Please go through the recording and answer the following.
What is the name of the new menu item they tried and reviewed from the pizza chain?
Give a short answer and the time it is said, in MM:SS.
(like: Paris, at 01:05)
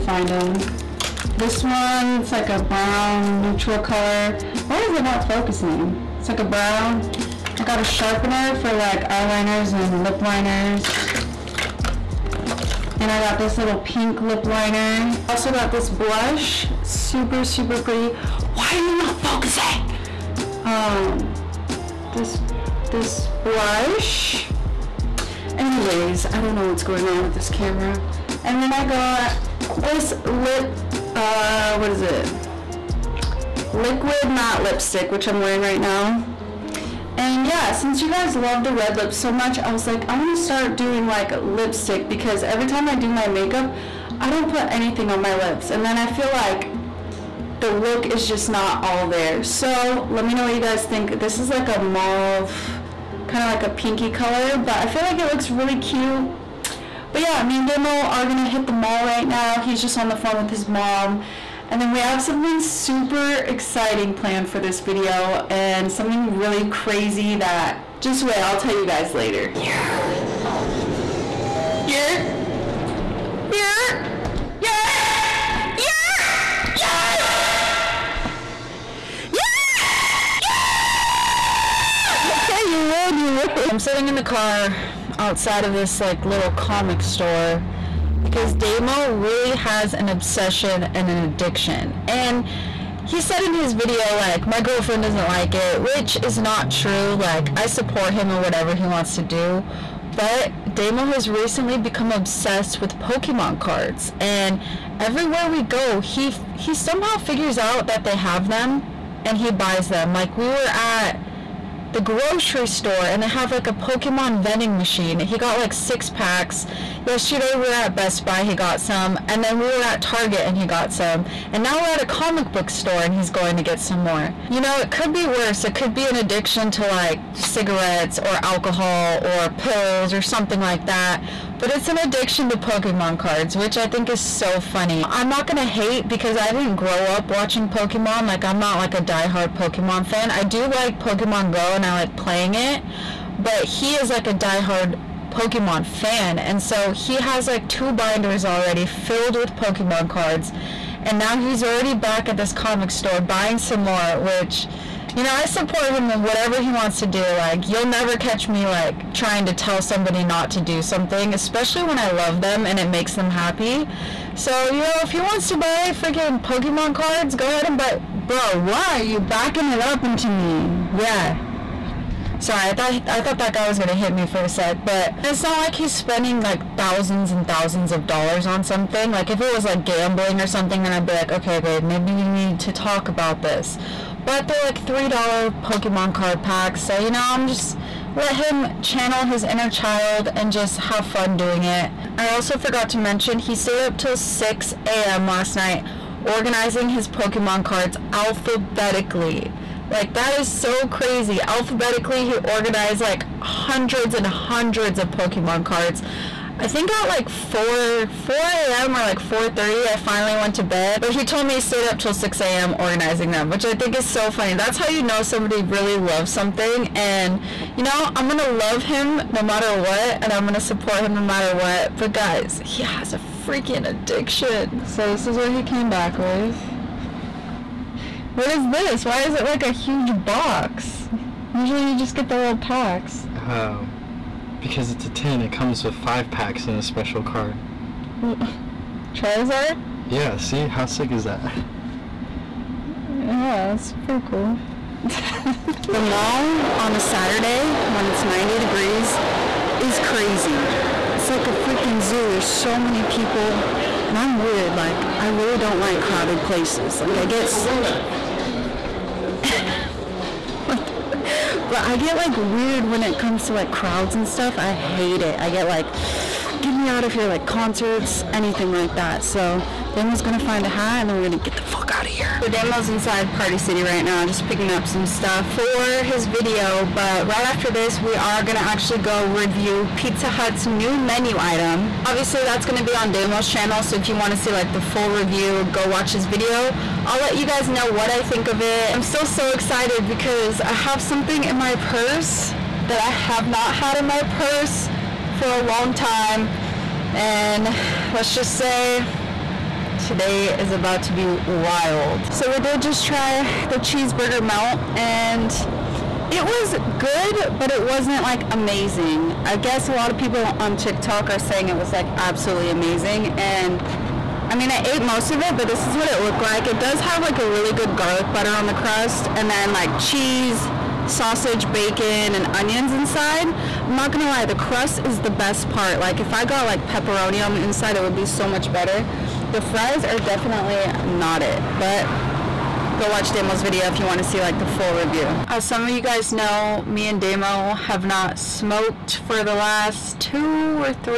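cheeseburger melt, at 05:03.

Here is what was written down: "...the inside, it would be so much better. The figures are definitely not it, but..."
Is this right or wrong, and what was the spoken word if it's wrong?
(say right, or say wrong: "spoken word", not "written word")
wrong: "fries", not "figures".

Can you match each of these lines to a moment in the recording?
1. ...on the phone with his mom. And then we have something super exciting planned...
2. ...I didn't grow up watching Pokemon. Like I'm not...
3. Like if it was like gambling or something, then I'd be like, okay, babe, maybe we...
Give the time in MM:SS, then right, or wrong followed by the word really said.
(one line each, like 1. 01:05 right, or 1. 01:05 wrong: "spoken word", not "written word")
1. 00:59 right
2. 02:16 right
3. 02:59 right.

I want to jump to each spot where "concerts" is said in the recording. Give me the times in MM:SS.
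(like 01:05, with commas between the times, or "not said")
04:27.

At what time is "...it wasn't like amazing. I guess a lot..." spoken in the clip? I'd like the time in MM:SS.
05:07.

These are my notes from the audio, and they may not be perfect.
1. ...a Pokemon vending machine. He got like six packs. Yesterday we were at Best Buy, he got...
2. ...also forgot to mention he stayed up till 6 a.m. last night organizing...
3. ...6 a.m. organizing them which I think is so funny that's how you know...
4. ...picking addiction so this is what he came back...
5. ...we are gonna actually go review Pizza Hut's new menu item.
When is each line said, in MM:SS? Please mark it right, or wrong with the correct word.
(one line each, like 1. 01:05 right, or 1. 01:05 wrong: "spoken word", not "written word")
1. 01:53 right
2. 03:12 right
3. 03:32 right
4. 03:43 wrong: "freaking", not "picking"
5. 04:38 right.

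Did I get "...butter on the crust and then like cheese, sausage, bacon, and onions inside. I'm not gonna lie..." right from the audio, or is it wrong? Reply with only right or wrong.
right.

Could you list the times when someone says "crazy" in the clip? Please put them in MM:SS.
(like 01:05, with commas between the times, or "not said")
01:06, 03:20, 04:09.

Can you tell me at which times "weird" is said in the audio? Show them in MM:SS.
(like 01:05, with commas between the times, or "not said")
04:14, 04:22.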